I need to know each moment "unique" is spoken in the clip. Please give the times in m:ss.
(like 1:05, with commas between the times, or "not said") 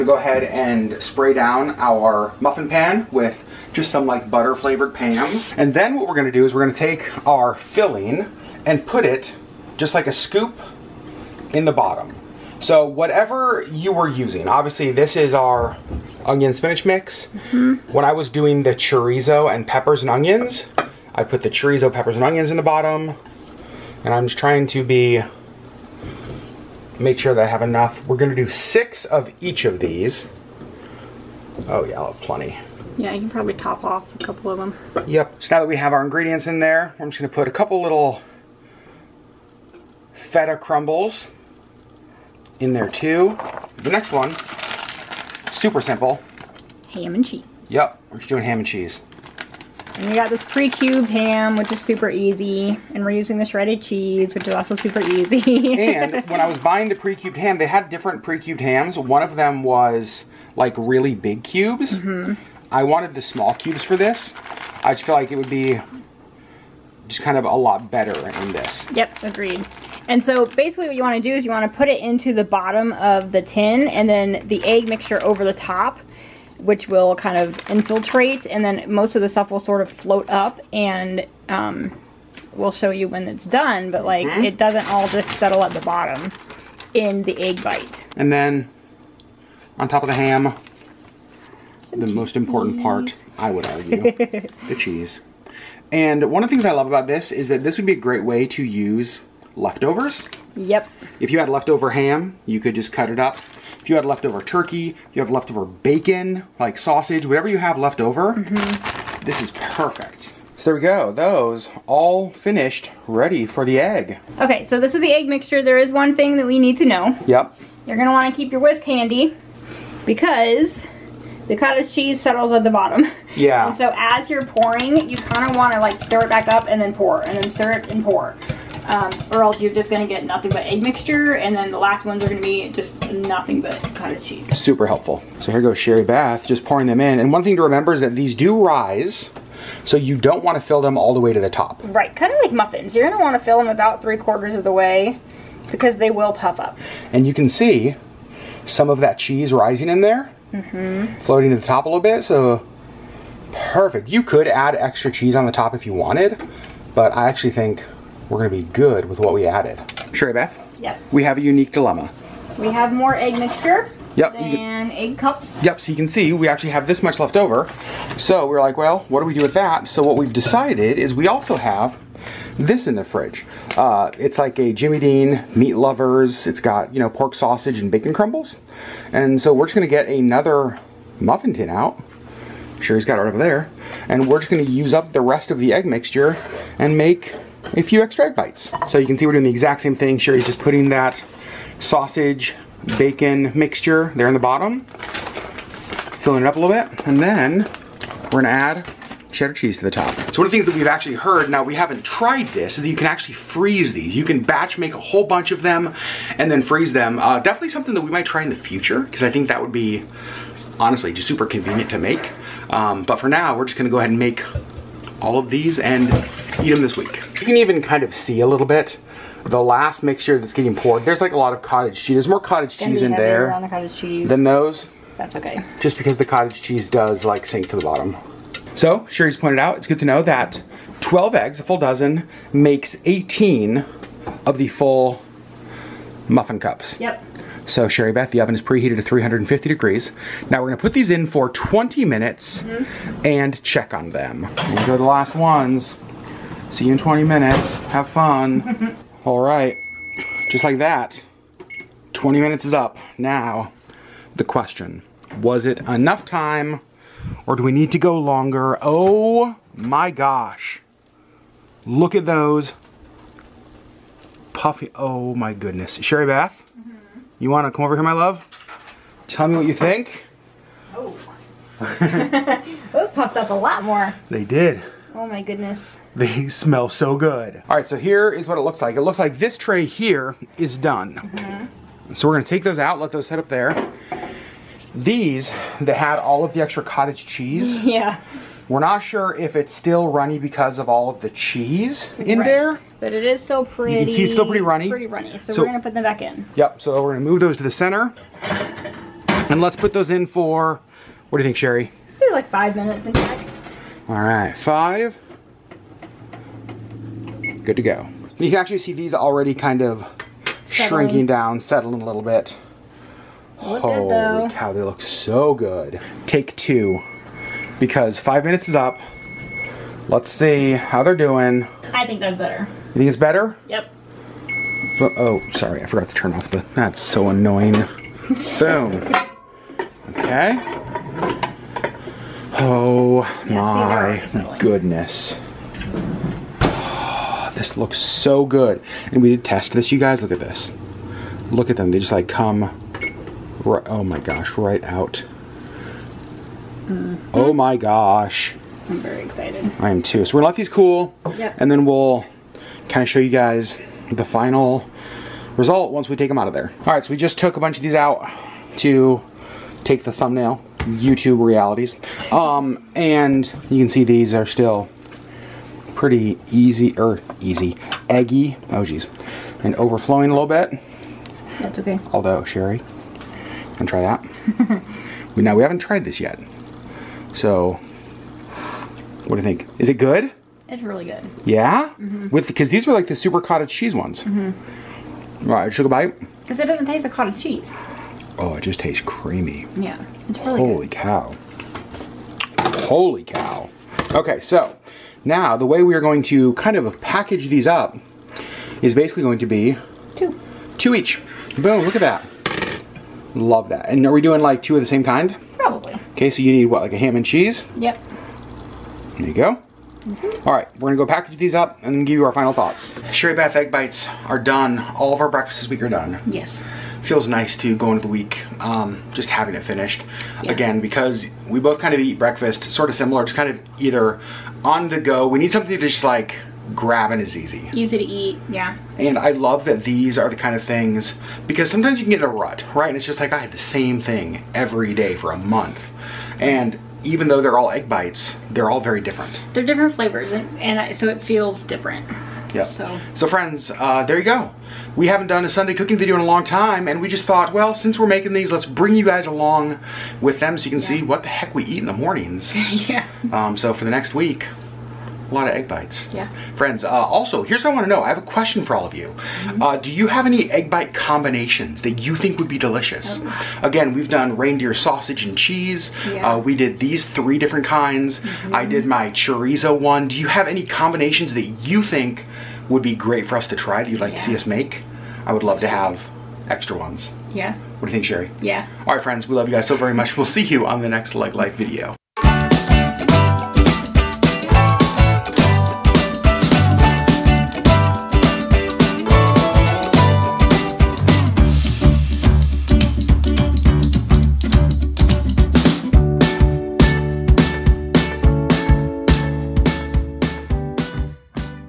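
2:41.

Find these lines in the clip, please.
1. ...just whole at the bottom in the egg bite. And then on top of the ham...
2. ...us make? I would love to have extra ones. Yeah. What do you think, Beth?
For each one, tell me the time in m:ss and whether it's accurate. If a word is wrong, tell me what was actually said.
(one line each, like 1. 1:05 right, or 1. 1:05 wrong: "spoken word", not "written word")
1. 1:25 wrong: "settle", not "whole"
2. 7:54 wrong: "Sherri", not "Beth".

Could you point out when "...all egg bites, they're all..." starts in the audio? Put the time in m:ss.
7:17.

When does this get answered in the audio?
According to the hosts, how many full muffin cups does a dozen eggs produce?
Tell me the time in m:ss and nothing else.
3:53.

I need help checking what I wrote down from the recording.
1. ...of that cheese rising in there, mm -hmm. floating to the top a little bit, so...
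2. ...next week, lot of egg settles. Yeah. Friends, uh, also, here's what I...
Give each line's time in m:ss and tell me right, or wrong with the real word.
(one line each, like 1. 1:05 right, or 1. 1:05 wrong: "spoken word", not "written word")
1. 2:28 right
2. 7:33 wrong: "bites", not "settles".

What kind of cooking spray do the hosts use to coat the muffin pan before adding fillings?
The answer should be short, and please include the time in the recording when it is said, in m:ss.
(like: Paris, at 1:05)
butter flavored Pam, at 0:04.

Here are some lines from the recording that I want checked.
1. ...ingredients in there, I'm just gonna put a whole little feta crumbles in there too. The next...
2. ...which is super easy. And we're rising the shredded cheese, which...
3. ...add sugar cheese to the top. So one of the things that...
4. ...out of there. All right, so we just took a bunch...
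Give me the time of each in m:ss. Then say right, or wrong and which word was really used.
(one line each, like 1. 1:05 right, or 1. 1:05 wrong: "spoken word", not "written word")
1. 0:36 wrong: "couple", not "whole"
2. 0:51 wrong: "using", not "rising"
3. 3:18 wrong: "cheddar", not "sugar"
4. 5:56 right.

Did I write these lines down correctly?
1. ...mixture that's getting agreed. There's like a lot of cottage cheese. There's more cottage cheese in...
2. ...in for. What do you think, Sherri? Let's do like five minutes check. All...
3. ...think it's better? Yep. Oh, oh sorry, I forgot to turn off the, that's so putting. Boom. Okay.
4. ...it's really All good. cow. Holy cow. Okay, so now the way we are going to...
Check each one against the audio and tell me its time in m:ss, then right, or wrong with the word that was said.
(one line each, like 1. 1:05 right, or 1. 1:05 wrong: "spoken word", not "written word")
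1. 3:40 wrong: "poured", not "agreed"
2. 5:00 right
3. 5:22 wrong: "annoying", not "putting"
4. 6:30 wrong: "Holy", not "All".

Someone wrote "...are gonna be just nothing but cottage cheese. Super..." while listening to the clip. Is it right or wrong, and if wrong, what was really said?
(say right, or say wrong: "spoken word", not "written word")
right.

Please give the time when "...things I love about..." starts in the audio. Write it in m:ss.
1:36.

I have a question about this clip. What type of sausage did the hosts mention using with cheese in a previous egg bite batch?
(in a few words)
reindeer sausage.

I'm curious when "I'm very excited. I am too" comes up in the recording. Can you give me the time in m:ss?
5:48.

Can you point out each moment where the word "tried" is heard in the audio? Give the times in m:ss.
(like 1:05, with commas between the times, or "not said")
3:22, 6:15.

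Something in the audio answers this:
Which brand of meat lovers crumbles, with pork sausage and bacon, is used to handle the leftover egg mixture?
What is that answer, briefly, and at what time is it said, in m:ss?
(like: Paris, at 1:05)
Jimmy Dean, at 2:54.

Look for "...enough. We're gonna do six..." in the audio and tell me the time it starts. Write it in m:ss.
0:27.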